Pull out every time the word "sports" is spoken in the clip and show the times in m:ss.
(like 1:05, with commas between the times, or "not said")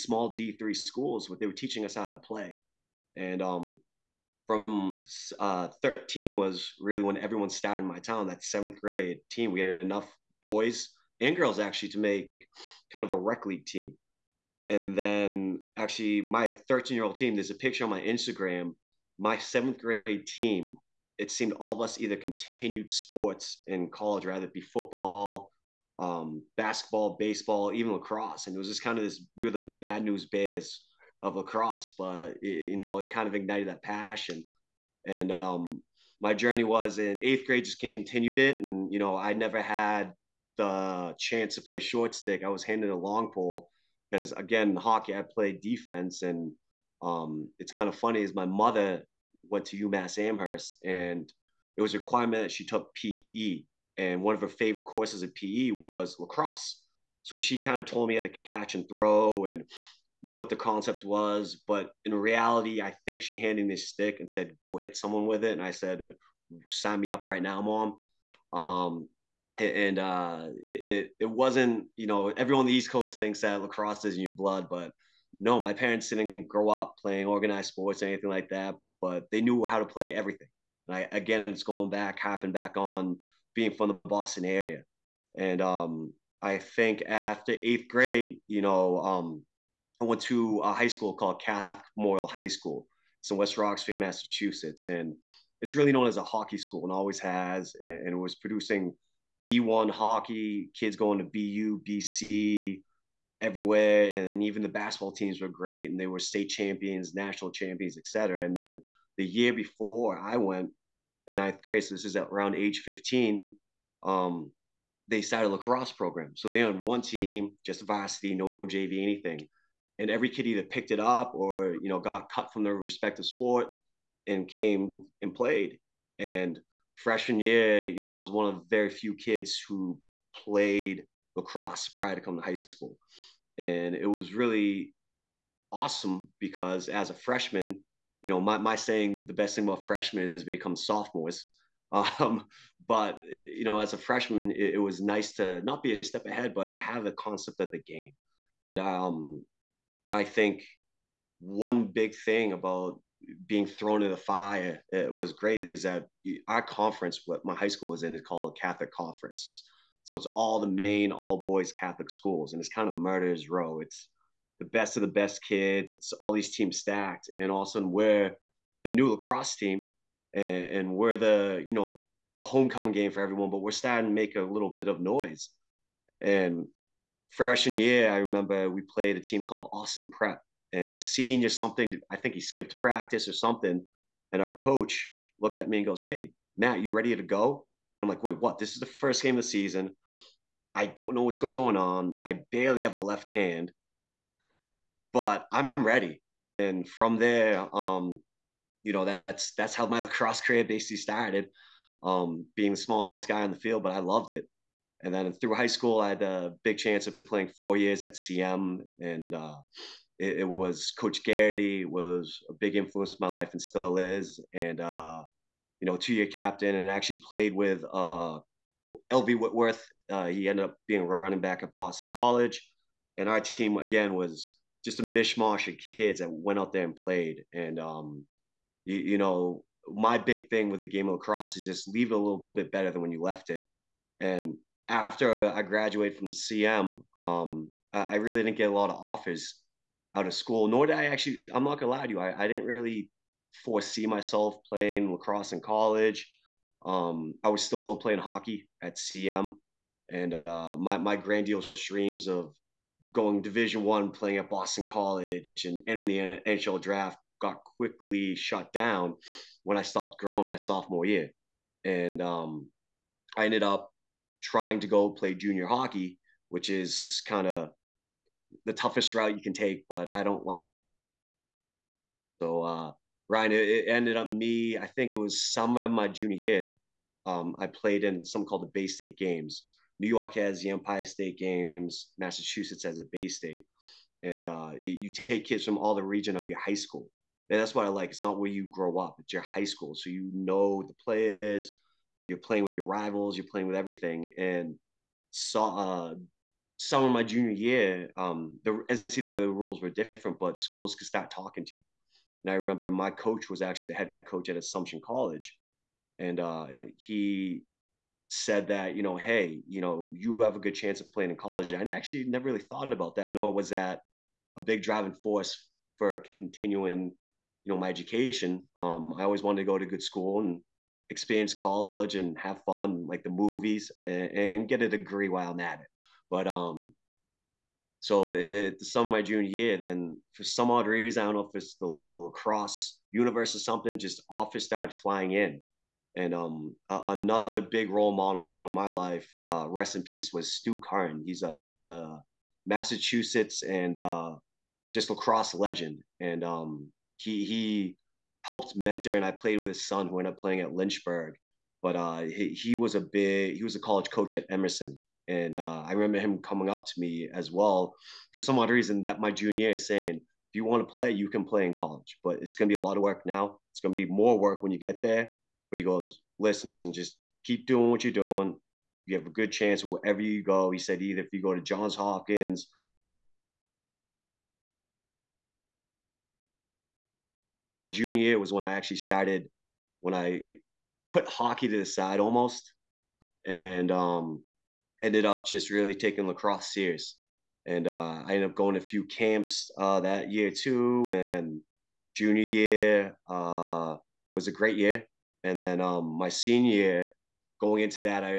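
0:22, 1:17, 2:03.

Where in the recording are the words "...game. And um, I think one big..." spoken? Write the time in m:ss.
2:27.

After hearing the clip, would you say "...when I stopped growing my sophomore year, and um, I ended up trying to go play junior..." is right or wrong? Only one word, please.
right.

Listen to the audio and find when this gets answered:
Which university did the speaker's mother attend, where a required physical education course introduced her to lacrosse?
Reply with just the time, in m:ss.
0:49.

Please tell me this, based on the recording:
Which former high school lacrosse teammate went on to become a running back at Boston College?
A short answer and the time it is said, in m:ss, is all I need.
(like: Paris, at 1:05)
LV Whitworth, at 3:39.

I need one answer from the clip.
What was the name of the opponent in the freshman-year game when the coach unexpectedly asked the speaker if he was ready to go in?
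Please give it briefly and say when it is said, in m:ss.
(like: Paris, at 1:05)
Austin Prep, at 2:59.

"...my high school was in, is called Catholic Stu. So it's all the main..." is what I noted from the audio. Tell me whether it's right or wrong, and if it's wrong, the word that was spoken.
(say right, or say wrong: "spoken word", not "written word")
wrong: "Conference", not "Stu".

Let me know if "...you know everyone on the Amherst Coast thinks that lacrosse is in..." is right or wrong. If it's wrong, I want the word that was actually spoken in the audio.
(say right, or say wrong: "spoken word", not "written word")
wrong: "East", not "Amherst".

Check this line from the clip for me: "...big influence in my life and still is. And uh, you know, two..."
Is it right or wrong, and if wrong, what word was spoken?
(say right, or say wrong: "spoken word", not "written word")
right.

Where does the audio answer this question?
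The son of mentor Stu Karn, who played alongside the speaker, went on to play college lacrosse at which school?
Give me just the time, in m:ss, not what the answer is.
5:50.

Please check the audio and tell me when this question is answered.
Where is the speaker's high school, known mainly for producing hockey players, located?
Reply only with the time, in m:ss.
1:33.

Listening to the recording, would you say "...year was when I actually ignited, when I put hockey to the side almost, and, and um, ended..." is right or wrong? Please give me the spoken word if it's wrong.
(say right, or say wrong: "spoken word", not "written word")
wrong: "started", not "ignited".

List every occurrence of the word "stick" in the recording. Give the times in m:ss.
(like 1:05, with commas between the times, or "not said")
0:42, 1:03.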